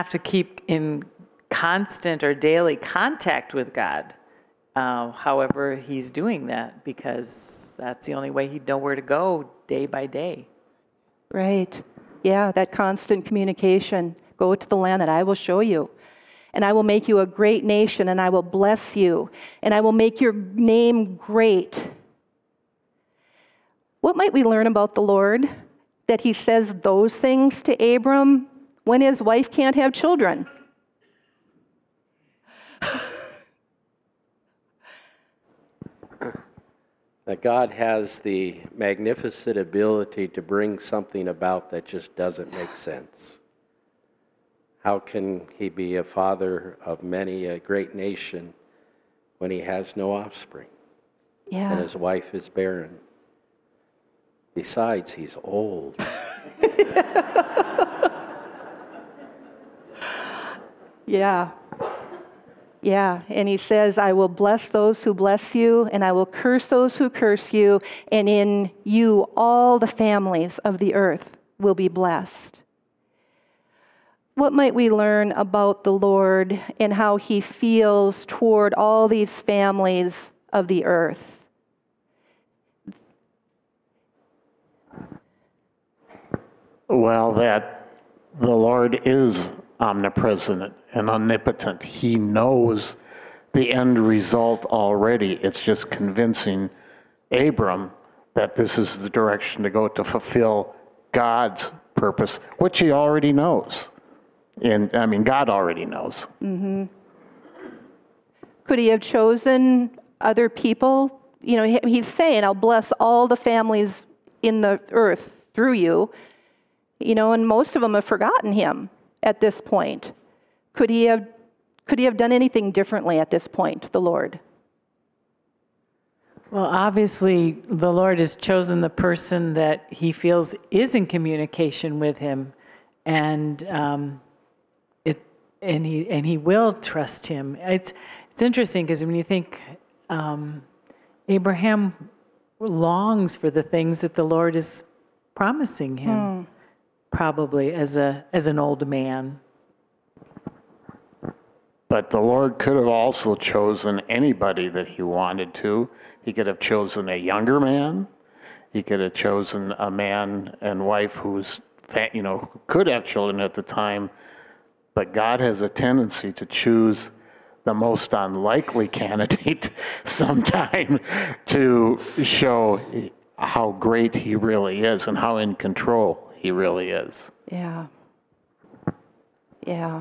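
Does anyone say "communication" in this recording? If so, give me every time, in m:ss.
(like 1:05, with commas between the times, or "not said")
0:13, 2:11.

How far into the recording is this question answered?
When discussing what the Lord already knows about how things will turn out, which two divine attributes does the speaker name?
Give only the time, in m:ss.
1:29.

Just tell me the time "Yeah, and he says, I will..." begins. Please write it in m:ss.
1:02.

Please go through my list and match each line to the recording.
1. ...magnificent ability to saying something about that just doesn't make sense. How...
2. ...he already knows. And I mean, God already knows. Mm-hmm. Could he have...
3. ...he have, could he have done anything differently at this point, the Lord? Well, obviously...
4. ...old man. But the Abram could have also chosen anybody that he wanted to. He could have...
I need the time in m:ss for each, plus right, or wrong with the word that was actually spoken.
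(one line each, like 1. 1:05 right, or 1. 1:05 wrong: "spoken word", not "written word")
1. 0:38 wrong: "bring", not "saying"
2. 1:42 right
3. 2:00 right
4. 2:28 wrong: "Lord", not "Abram".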